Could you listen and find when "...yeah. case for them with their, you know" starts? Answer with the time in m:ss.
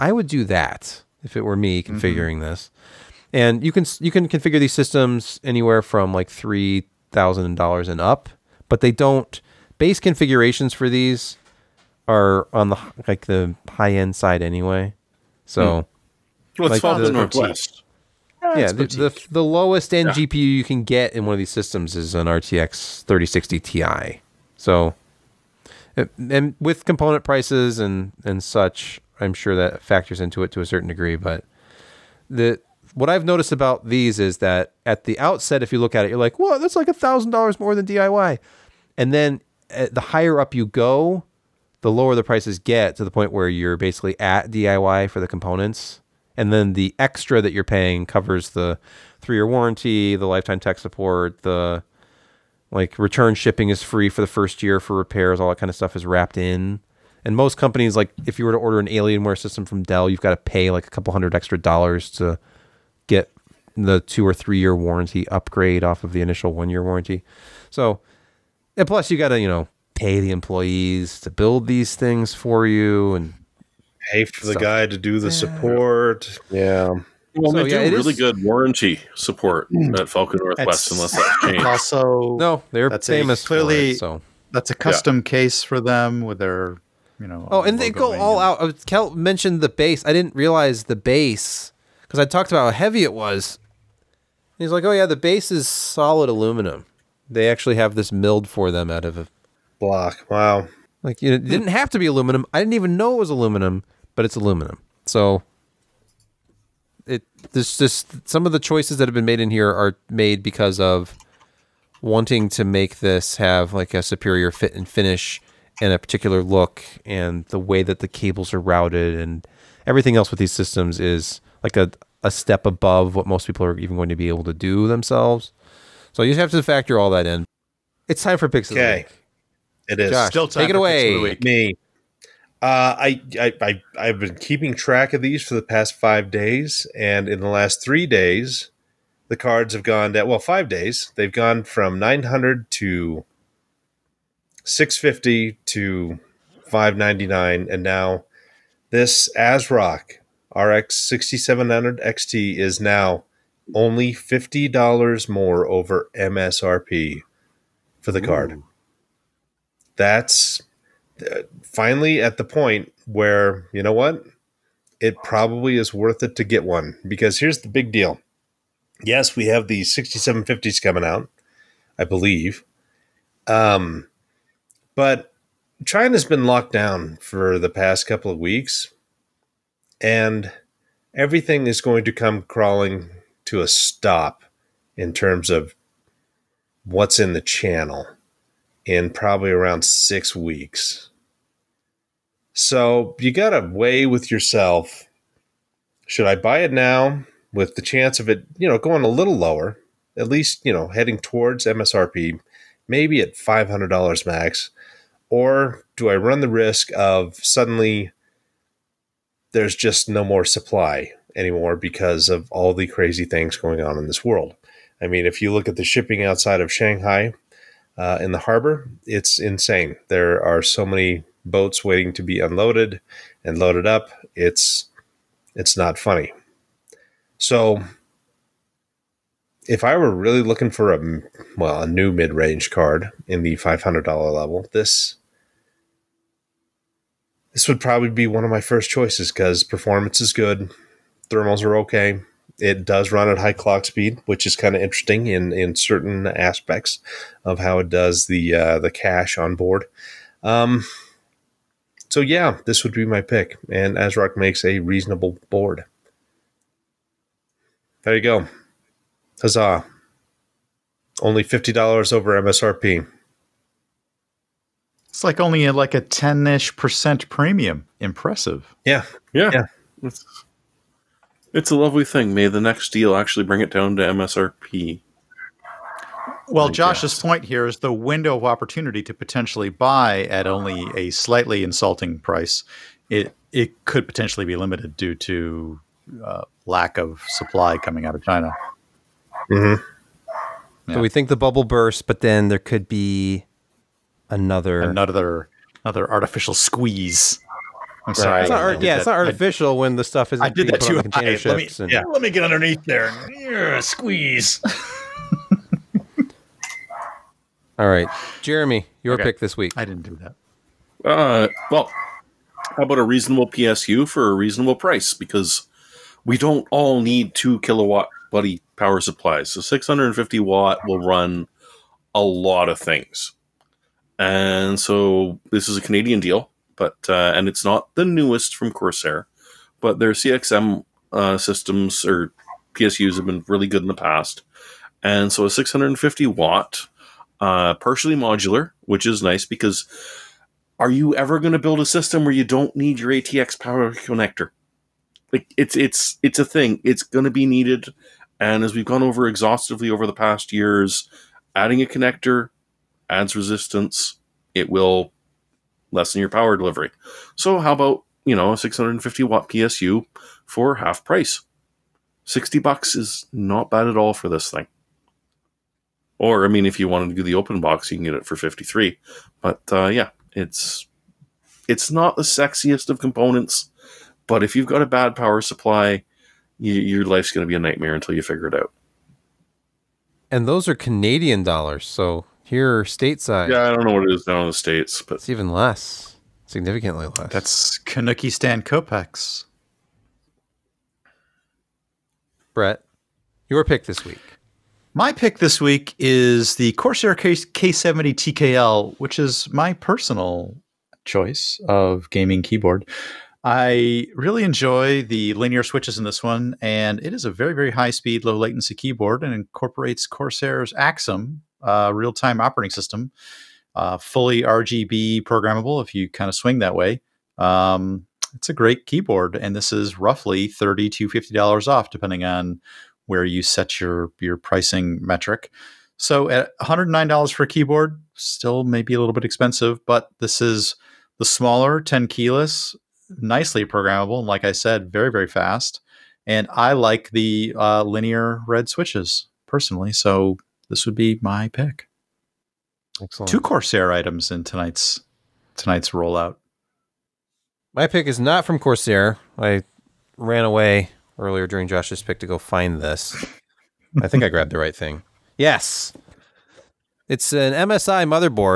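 1:25.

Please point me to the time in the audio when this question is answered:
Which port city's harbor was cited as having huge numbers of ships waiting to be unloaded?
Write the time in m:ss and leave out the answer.
3:36.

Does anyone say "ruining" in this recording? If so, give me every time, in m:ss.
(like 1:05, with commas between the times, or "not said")
not said.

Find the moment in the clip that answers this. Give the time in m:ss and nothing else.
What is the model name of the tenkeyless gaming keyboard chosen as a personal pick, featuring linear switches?
6:37.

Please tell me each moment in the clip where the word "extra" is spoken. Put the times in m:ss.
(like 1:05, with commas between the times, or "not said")
0:46, 1:01.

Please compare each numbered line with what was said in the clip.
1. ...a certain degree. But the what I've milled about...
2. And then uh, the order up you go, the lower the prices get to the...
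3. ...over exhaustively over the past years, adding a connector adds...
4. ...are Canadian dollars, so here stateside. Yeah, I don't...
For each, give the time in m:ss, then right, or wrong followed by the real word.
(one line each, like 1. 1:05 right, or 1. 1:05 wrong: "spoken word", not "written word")
1. 0:30 wrong: "noticed", not "milled"
2. 0:38 wrong: "higher", not "order"
3. 5:49 right
4. 6:20 right.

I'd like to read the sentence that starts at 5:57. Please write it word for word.
So how about, you know, a 650 watt PSU for half price?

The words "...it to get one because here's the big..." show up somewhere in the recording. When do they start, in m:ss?
2:46.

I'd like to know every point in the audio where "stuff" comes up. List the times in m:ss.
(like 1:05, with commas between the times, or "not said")
0:55, 1:14, 5:00.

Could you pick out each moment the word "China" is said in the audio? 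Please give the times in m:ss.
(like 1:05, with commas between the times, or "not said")
2:55, 4:48.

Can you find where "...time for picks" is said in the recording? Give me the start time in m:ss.
2:08.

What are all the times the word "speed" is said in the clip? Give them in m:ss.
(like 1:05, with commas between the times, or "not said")
4:03, 6:47.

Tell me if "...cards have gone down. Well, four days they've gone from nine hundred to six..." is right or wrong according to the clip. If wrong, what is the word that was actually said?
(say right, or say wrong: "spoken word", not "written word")
wrong: "five", not "four".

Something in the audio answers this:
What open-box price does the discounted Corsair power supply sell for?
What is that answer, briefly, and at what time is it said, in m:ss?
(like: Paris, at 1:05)
53, at 6:08.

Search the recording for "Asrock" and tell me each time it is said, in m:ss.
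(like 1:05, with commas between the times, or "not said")
2:29, 4:13.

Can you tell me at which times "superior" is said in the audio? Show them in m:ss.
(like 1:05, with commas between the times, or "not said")
1:54.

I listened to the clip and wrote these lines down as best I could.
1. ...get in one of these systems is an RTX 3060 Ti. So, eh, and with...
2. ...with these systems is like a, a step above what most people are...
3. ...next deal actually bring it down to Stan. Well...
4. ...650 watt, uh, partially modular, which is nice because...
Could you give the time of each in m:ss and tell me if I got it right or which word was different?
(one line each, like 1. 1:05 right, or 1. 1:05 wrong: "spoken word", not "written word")
1. 0:20 right
2. 2:00 right
3. 4:32 wrong: "MSRP", not "Stan"
4. 5:35 right.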